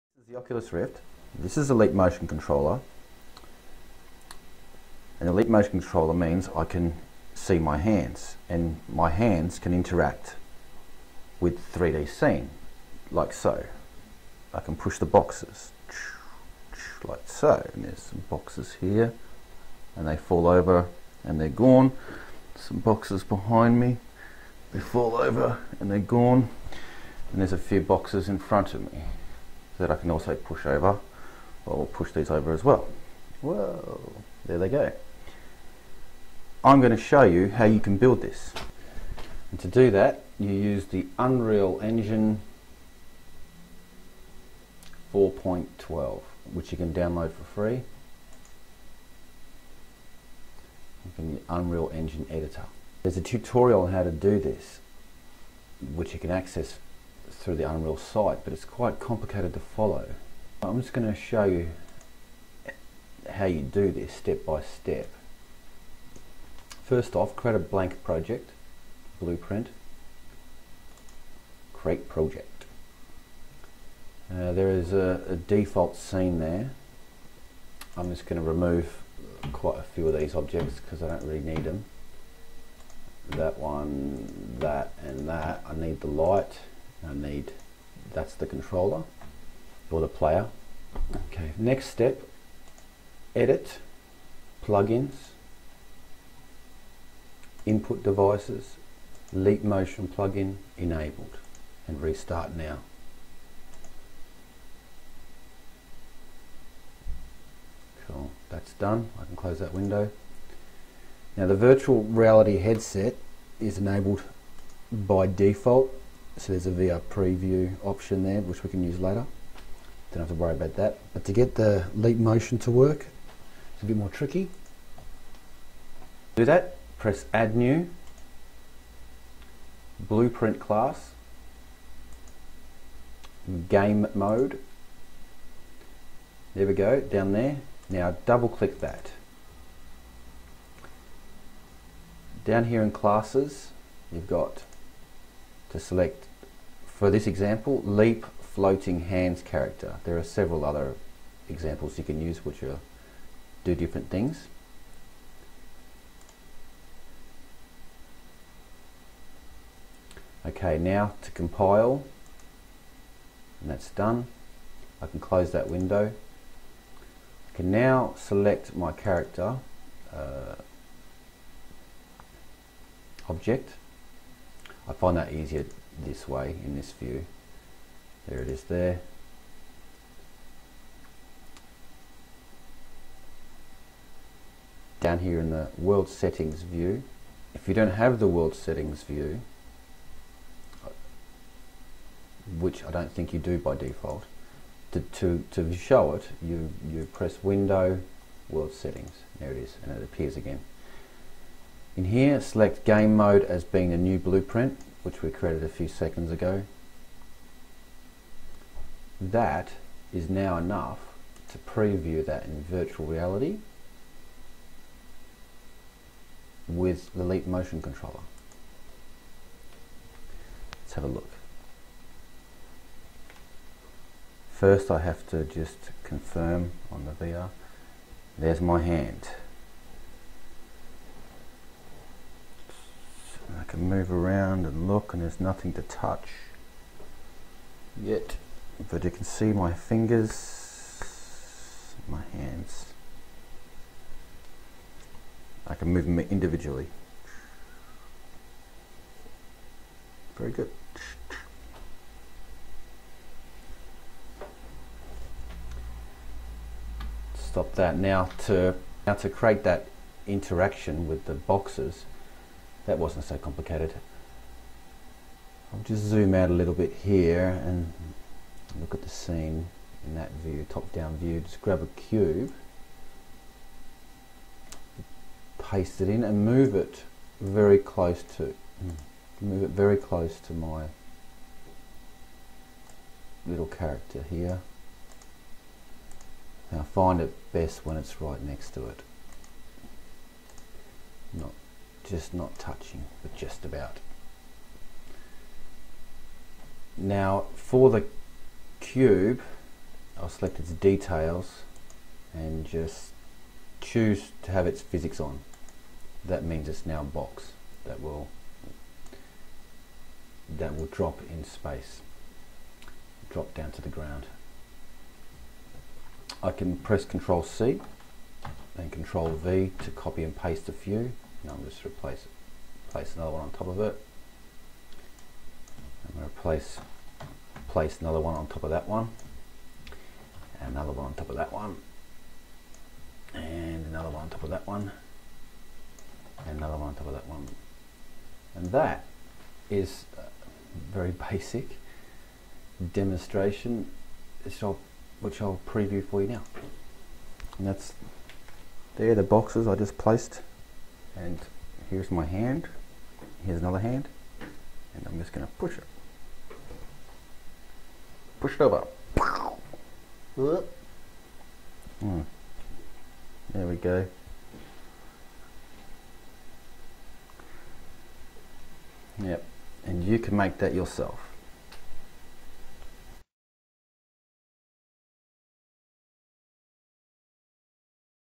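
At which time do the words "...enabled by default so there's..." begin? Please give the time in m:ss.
1:53.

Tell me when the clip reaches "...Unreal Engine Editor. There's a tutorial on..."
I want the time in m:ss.
0:51.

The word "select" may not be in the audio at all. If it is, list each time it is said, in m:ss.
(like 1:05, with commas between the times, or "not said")
2:25, 2:48, 3:22, 5:00.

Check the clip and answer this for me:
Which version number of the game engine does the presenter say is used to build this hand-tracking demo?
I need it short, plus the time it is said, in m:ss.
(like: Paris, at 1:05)
4.12, at 0:45.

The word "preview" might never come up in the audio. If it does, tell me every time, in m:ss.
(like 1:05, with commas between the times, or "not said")
1:57, 3:31, 5:45.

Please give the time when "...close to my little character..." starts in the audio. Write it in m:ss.
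4:39.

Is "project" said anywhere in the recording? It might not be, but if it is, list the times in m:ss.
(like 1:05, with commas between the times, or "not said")
1:08, 1:12.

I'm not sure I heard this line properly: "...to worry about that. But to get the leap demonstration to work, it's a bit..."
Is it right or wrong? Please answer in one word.
wrong.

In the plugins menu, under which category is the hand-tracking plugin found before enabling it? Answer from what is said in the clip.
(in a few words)
Input devices.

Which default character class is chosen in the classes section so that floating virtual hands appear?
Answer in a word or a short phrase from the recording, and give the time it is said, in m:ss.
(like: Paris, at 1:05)
Leap floating hands character, at 2:27.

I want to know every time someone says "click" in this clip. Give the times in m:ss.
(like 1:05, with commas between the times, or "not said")
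2:18.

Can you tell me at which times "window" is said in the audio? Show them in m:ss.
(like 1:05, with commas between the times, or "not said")
1:49, 2:45, 3:17.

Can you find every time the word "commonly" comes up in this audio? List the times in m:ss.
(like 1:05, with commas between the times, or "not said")
not said.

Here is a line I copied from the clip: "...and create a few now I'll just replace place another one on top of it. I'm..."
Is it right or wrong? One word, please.
wrong.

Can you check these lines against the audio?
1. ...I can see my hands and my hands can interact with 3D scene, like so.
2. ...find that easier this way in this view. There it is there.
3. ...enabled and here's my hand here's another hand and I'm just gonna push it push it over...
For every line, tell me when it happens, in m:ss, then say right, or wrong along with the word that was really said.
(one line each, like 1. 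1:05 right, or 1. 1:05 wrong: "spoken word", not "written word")
1. 0:06 right
2. 2:54 right
3. 5:49 wrong: "placed", not "enabled".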